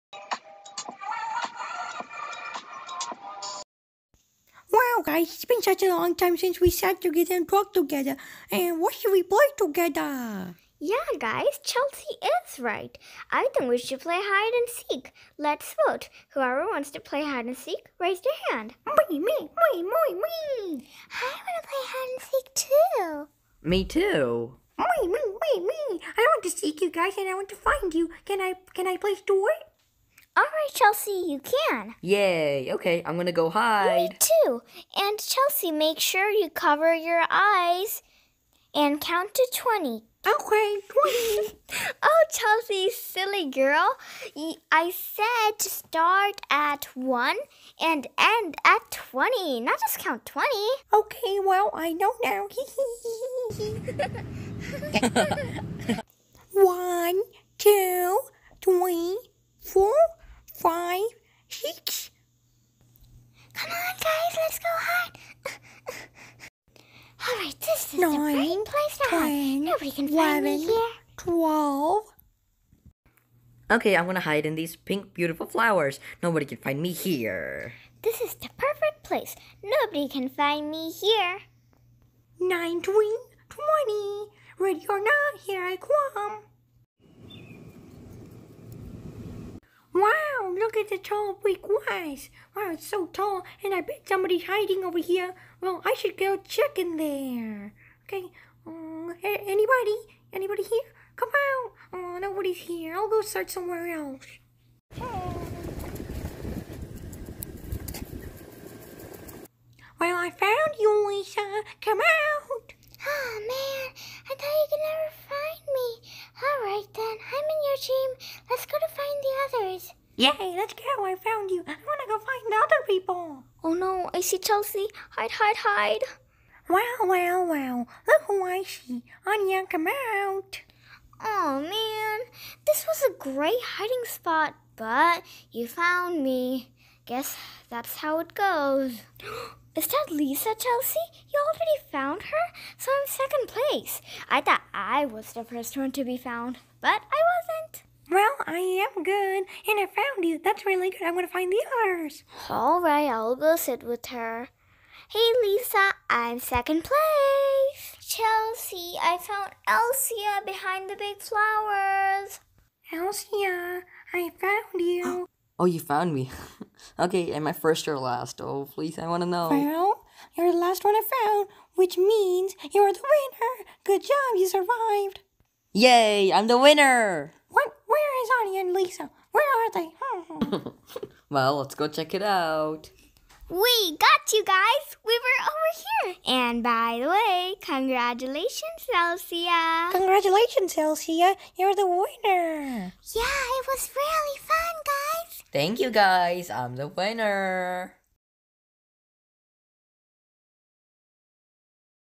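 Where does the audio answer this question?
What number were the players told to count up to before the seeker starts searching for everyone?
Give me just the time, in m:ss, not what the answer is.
0:39.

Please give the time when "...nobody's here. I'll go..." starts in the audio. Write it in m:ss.
1:42.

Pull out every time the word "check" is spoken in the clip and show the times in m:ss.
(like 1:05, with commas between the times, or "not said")
1:36, 3:01.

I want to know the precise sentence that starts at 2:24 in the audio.
I thought I was the first one to be found, but I well, I am good, and I found you.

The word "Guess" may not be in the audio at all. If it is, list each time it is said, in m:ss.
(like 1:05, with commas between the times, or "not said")
2:17.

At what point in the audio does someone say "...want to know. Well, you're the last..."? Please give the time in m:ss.
2:49.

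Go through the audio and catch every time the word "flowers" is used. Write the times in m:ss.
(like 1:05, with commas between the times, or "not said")
1:15, 2:41.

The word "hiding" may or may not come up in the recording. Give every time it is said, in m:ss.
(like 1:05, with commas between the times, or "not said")
1:34, 2:13.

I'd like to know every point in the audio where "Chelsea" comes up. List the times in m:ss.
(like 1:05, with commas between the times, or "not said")
0:11, 0:30, 0:35, 0:42, 2:04, 2:20, 2:38.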